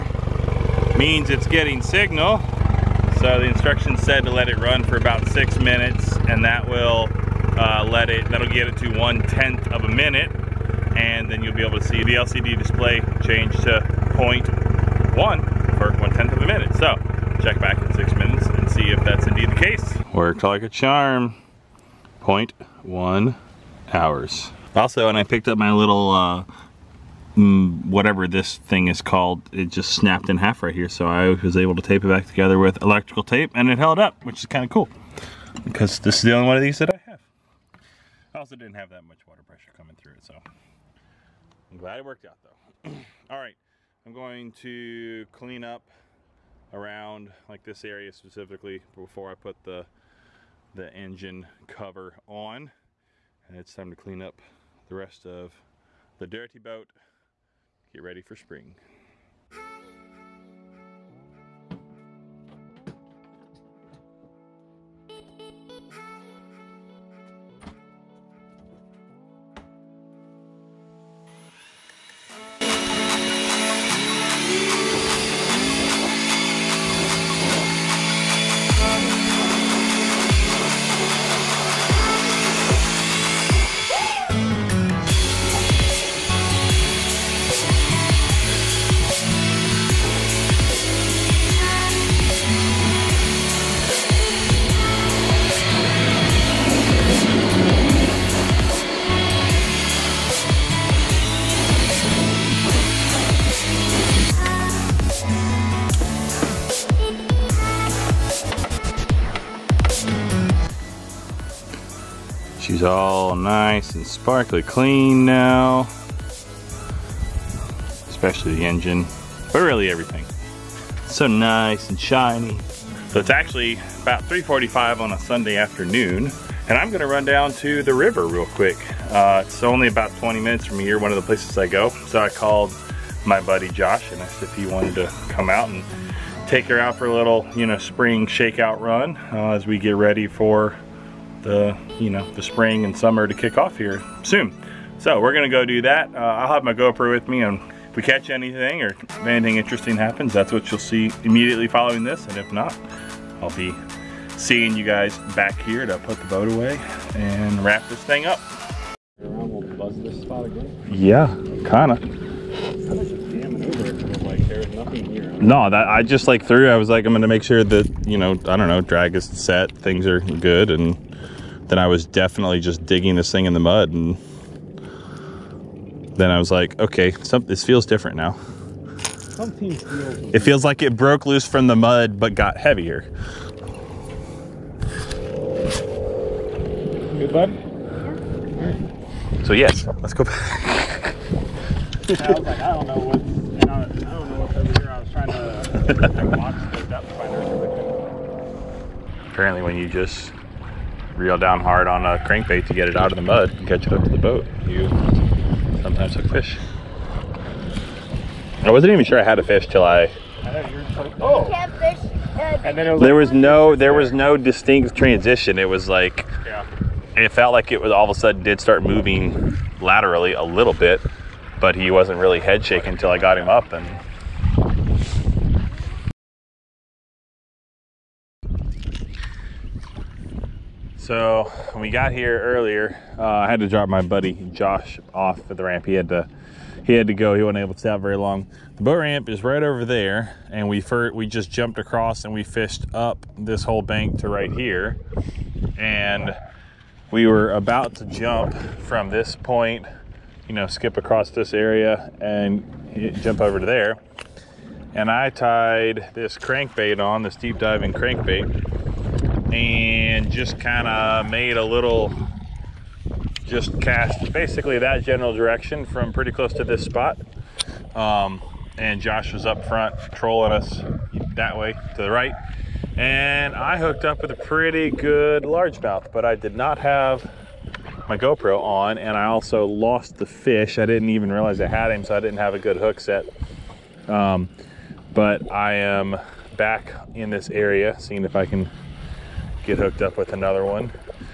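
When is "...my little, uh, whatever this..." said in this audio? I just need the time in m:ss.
0:25.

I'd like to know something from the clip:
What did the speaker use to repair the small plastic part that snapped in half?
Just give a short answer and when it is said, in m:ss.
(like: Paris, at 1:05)
electrical tape, at 0:32.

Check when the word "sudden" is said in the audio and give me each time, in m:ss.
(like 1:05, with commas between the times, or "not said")
3:38.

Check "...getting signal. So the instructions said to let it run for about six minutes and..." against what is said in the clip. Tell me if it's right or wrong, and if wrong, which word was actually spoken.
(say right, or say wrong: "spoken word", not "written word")
right.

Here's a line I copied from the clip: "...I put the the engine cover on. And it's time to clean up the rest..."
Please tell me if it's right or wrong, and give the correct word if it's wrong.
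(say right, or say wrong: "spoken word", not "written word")
right.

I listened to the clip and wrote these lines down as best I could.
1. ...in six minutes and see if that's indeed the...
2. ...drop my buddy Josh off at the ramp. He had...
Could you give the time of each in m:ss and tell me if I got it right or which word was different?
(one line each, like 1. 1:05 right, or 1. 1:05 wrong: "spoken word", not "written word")
1. 0:17 right
2. 3:53 right.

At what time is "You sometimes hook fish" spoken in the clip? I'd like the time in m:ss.
3:24.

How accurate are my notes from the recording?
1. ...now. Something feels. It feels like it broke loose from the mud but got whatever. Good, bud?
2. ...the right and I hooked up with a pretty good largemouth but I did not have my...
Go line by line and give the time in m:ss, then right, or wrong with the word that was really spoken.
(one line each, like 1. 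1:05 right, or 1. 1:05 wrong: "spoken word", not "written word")
1. 2:58 wrong: "heavier", not "whatever"
2. 4:32 right.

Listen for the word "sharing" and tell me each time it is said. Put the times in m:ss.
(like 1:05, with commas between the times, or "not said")
not said.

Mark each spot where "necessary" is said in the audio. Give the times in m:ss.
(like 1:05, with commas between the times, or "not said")
not said.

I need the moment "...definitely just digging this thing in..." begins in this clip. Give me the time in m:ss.
2:52.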